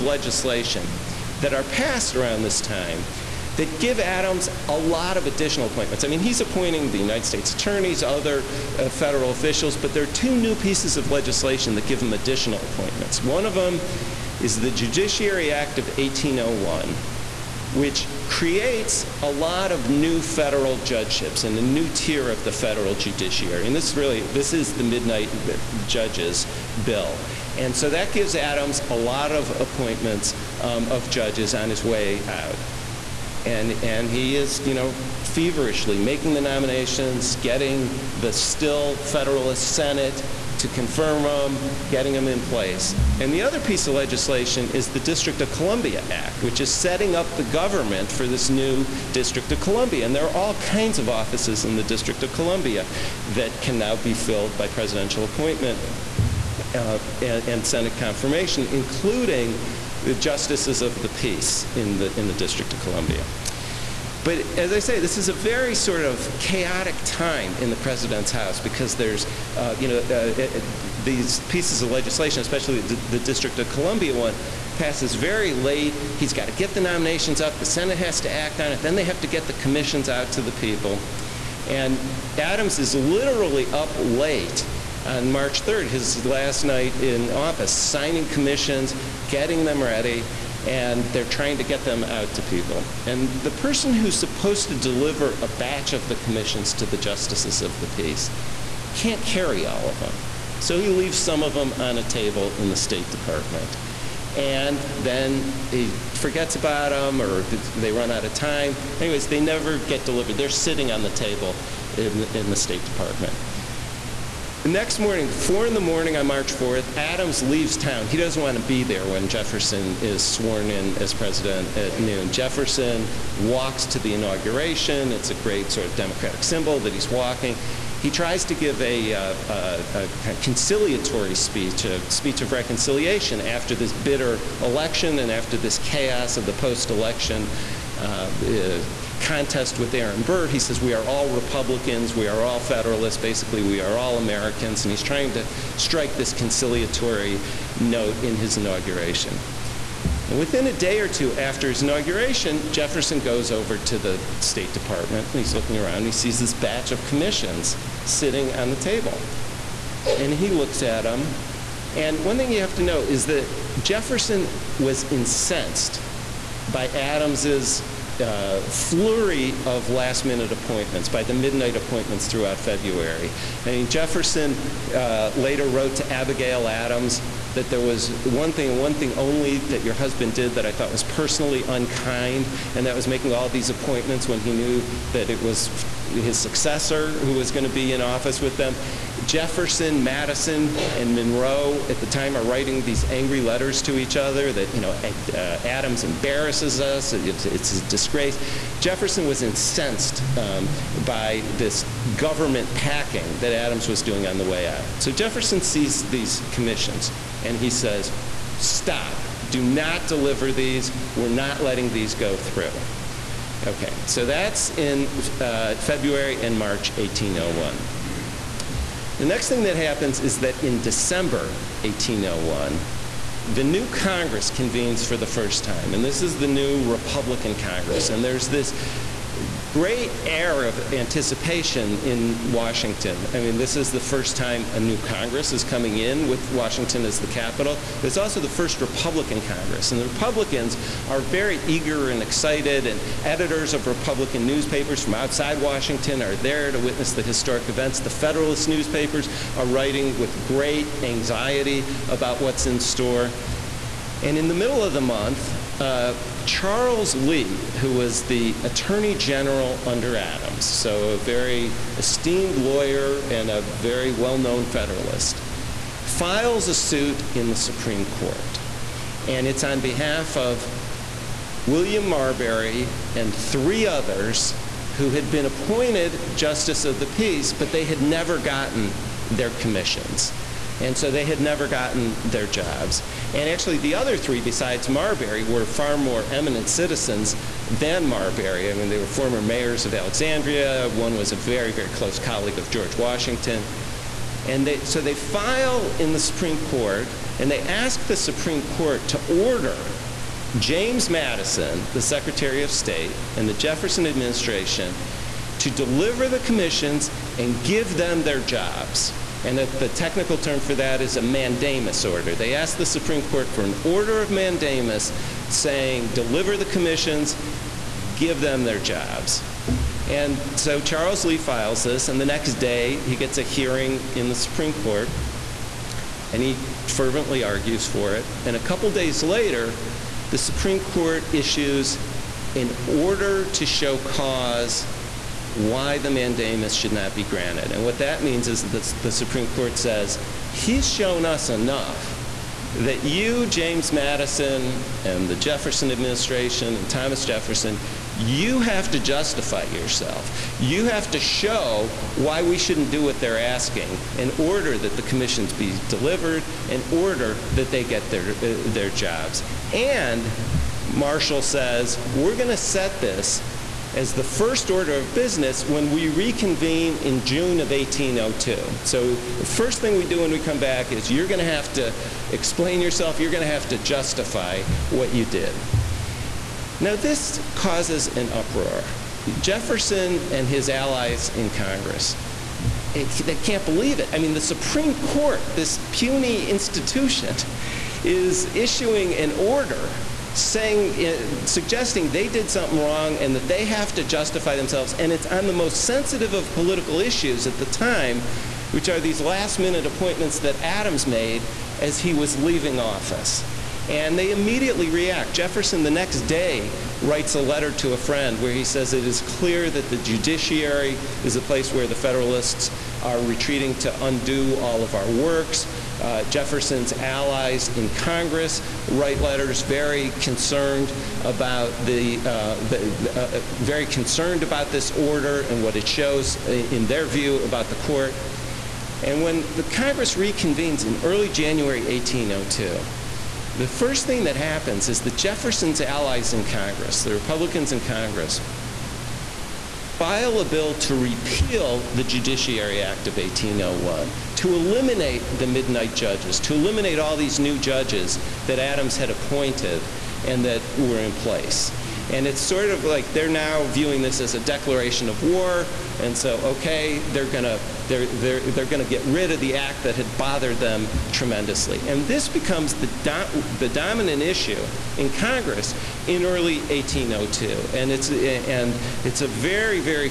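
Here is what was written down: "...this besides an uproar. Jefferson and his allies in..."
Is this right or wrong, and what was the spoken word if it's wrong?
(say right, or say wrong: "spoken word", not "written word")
wrong: "causes", not "besides".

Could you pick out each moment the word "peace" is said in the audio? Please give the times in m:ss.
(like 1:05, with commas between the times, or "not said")
1:01, 1:37, 4:37.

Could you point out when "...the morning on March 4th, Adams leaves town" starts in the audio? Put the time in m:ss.
1:55.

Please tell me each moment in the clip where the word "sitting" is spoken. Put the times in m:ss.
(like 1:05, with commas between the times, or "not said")
1:50, 2:38.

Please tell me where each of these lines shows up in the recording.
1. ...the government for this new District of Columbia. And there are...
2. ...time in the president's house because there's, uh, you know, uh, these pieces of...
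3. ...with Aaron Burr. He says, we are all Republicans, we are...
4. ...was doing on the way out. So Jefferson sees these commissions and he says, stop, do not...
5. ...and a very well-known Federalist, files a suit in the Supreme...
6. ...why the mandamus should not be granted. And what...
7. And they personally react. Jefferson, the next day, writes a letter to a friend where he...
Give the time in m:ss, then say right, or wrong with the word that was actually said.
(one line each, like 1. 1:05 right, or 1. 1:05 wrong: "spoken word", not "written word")
1. 0:47 right
2. 1:07 right
3. 2:19 right
4. 3:23 right
5. 4:23 right
6. 5:35 right
7. 6:43 wrong: "immediately", not "personally".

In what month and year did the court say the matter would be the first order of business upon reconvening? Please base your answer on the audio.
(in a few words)
June 1802.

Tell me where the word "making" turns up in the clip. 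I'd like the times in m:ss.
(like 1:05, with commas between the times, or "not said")
0:35, 3:03.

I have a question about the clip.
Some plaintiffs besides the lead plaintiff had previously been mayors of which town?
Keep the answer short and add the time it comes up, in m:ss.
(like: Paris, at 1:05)
Alexandria, at 4:49.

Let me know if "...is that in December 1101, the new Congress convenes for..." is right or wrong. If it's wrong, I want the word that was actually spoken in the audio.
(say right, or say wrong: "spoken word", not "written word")
wrong: "1801", not "1101".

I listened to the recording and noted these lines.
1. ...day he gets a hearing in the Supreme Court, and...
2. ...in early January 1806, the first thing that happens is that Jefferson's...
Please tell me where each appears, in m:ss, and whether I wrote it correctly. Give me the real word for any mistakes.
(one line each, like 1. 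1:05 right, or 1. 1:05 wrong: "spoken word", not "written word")
1. 5:22 right
2. 7:10 wrong: "1802", not "1806".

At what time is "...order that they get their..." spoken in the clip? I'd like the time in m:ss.
5:56.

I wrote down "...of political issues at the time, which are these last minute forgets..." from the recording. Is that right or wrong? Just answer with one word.
wrong.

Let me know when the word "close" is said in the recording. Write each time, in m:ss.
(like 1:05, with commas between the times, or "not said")
4:51.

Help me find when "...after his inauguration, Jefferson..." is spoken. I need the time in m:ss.
2:31.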